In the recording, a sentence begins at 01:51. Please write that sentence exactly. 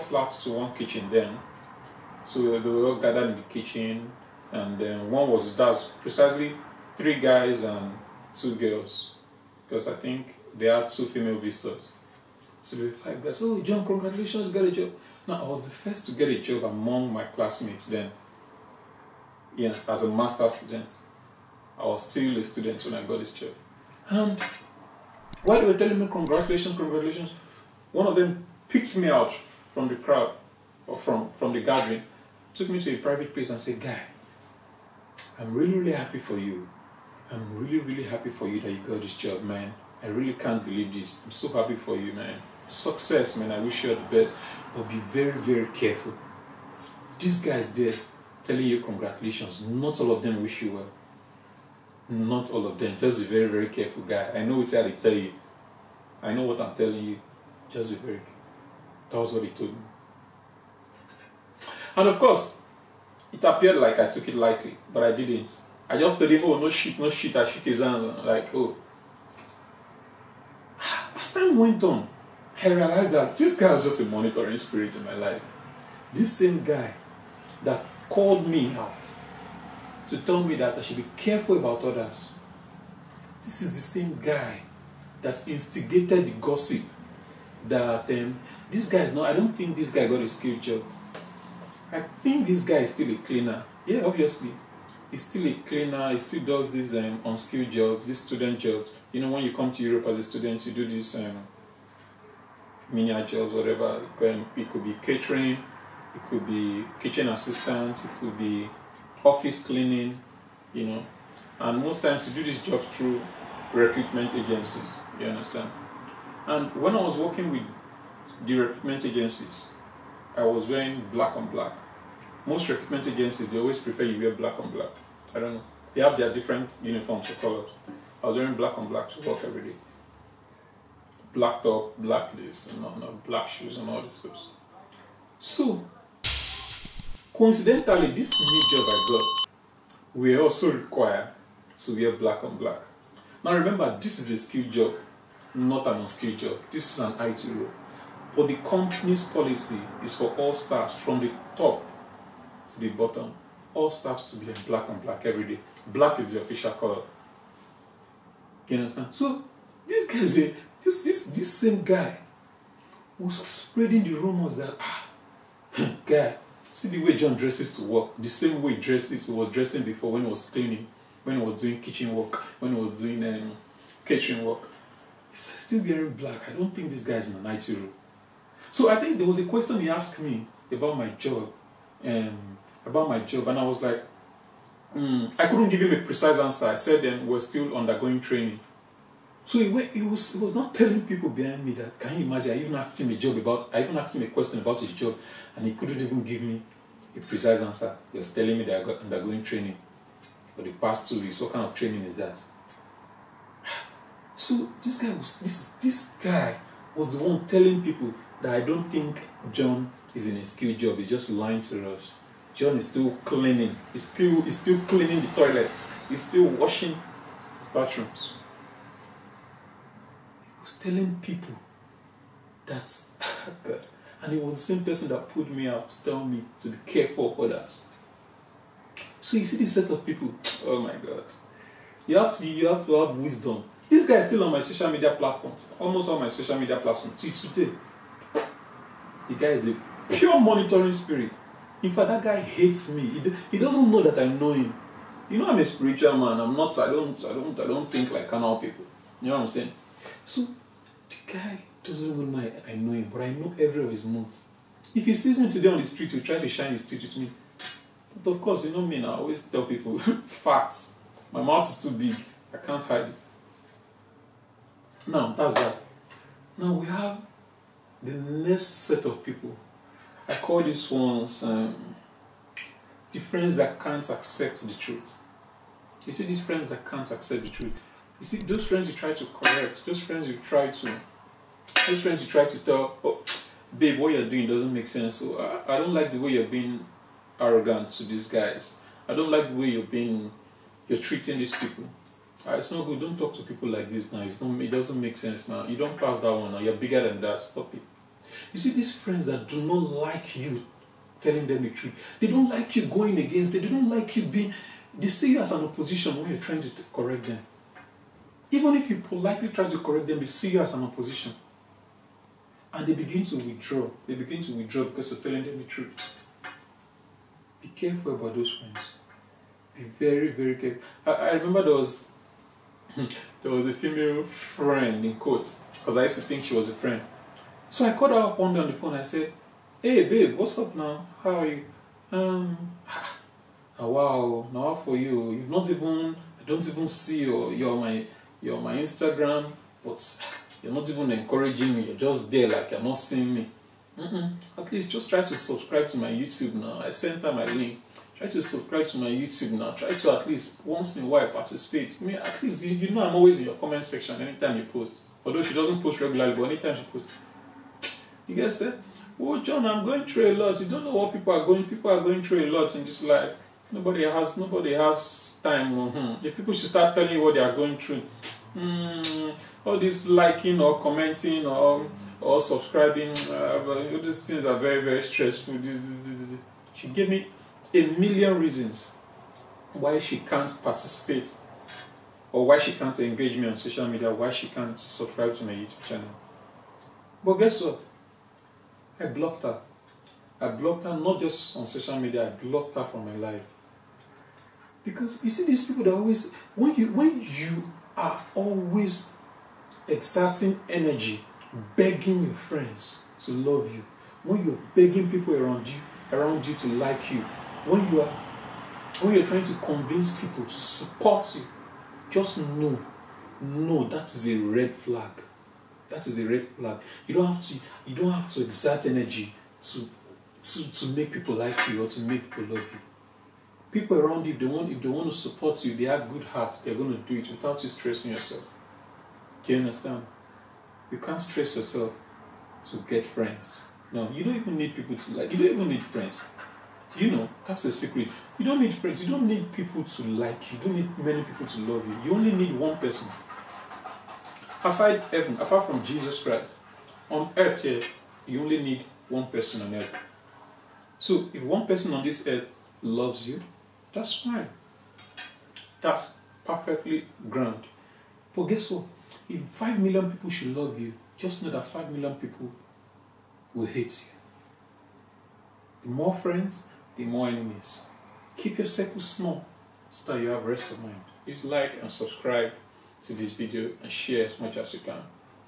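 And most times you do these jobs through recruitment agencies, you understand?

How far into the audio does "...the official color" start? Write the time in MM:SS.
02:36.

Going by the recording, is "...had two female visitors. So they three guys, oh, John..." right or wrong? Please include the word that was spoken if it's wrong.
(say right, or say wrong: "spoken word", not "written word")
wrong: "five", not "three".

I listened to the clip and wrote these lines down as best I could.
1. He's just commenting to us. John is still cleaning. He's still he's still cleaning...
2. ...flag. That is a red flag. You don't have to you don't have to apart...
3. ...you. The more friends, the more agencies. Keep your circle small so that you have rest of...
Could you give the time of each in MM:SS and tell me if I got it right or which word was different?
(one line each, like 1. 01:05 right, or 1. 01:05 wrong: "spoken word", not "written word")
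1. 03:30 wrong: "lying", not "commenting"
2. 06:54 wrong: "exert", not "apart"
3. 07:44 wrong: "enemies", not "agencies".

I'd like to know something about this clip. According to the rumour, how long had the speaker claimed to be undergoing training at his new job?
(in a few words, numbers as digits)
2 weeks.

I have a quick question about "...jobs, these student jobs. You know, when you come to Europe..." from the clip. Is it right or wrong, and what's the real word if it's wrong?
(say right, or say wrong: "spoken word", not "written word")
right.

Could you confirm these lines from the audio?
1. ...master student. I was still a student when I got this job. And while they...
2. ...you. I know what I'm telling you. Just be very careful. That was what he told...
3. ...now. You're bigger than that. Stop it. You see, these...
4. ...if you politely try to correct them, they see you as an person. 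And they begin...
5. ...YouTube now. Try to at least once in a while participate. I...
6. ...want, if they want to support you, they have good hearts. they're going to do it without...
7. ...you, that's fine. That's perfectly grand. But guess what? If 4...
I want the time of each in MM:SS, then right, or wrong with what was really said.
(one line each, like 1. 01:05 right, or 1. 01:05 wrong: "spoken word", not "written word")
1. 00:20 right
2. 00:55 right
3. 04:56 right
4. 05:08 wrong: "opposition", not "person"
5. 05:49 right
6. 07:04 right
7. 07:33 wrong: "5", not "4".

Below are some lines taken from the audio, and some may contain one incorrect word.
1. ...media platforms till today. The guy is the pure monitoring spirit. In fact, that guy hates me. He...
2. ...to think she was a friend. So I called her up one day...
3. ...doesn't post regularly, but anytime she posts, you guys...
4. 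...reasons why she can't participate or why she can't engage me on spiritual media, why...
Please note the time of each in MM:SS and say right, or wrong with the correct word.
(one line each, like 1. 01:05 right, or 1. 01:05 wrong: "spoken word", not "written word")
1. 03:56 right
2. 05:26 right
3. 05:55 right
4. 06:18 wrong: "social", not "spiritual".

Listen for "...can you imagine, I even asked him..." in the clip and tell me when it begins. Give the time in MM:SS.
03:11.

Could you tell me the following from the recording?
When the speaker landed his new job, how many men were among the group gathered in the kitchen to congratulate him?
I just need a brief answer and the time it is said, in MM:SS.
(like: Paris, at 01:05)
3, at 00:06.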